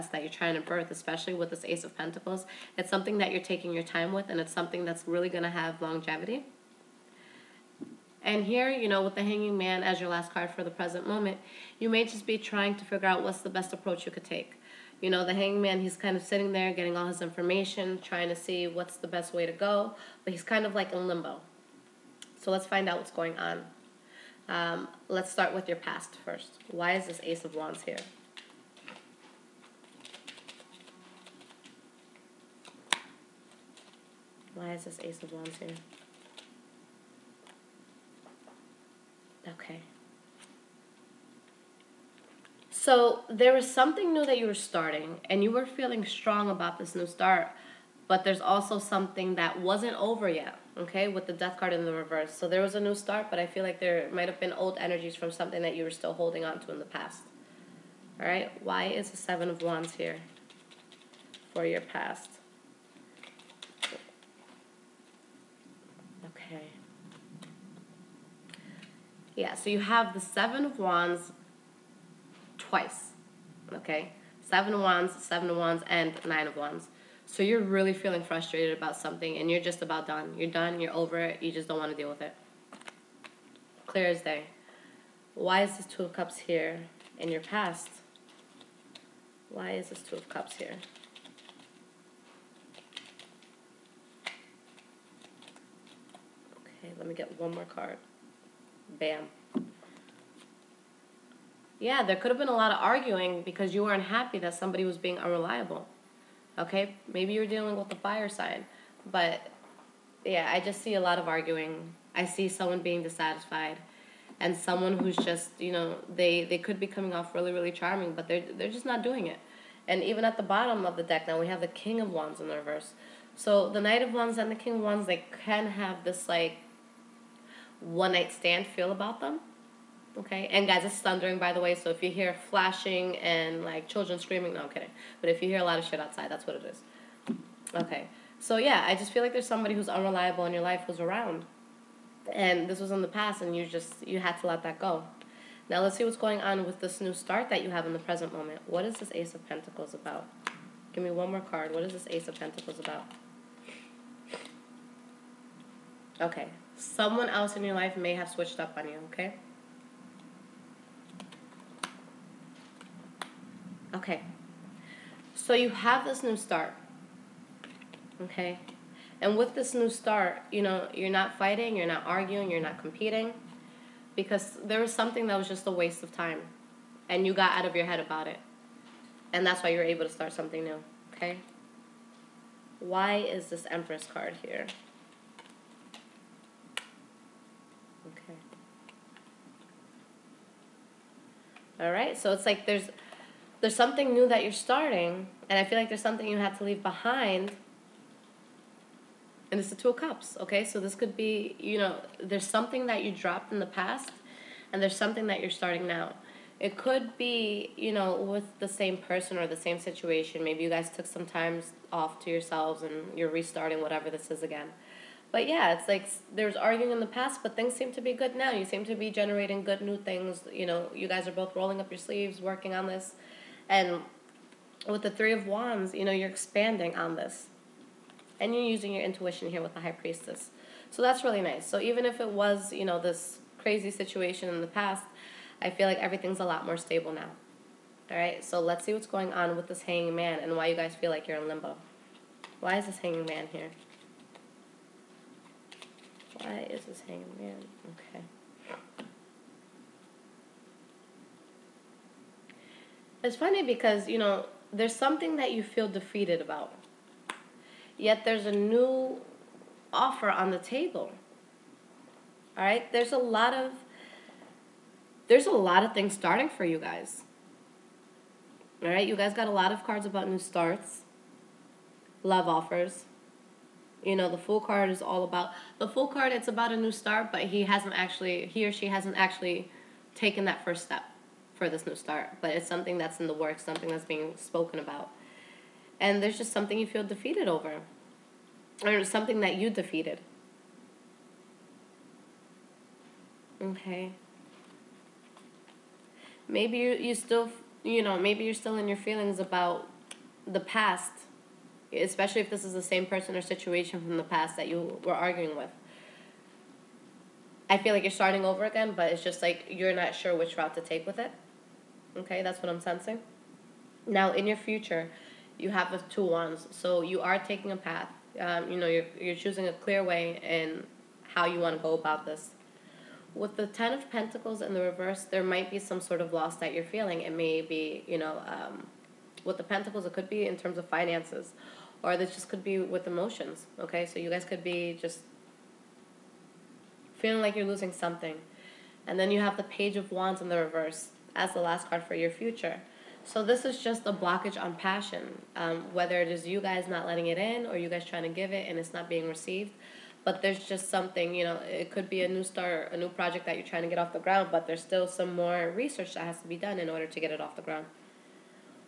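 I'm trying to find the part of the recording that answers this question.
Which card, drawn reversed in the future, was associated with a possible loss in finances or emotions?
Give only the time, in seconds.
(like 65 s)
323 s.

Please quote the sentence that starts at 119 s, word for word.
And even at the bottom of the deck now we have the King of Wands in the reverse.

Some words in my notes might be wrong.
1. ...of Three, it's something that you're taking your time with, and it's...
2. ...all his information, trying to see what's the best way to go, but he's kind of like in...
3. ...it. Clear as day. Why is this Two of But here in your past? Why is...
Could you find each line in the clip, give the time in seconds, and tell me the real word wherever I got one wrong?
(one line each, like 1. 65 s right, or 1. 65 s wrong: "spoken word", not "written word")
1. 1 s wrong: "Pentacles", not "Three"
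2. 16 s right
3. 82 s wrong: "Cups", not "But".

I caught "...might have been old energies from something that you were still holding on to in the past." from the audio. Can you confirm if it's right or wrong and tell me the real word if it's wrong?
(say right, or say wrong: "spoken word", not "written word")
right.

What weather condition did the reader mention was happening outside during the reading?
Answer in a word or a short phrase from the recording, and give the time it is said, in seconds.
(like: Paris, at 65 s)
Thundering, at 130 s.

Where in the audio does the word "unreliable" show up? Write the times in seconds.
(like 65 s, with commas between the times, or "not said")
105 s, 139 s.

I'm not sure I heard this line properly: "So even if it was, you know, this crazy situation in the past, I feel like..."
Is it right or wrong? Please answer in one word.
right.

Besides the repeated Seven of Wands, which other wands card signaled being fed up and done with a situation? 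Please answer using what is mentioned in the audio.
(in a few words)
Nine of Wands.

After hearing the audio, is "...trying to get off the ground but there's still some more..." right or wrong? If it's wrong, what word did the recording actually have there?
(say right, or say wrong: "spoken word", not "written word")
right.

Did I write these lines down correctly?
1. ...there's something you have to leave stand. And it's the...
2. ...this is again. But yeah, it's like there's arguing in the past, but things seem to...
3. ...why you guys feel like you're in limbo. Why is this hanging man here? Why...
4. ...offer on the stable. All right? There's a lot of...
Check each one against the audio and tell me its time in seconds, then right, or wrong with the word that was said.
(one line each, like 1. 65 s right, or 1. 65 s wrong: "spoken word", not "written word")
1. 195 s wrong: "behind", not "stand"
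2. 214 s right
3. 240 s right
4. 259 s wrong: "table", not "stable".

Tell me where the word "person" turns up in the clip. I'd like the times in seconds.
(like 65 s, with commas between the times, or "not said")
208 s, 303 s.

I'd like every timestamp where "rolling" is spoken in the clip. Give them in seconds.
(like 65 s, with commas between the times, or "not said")
221 s.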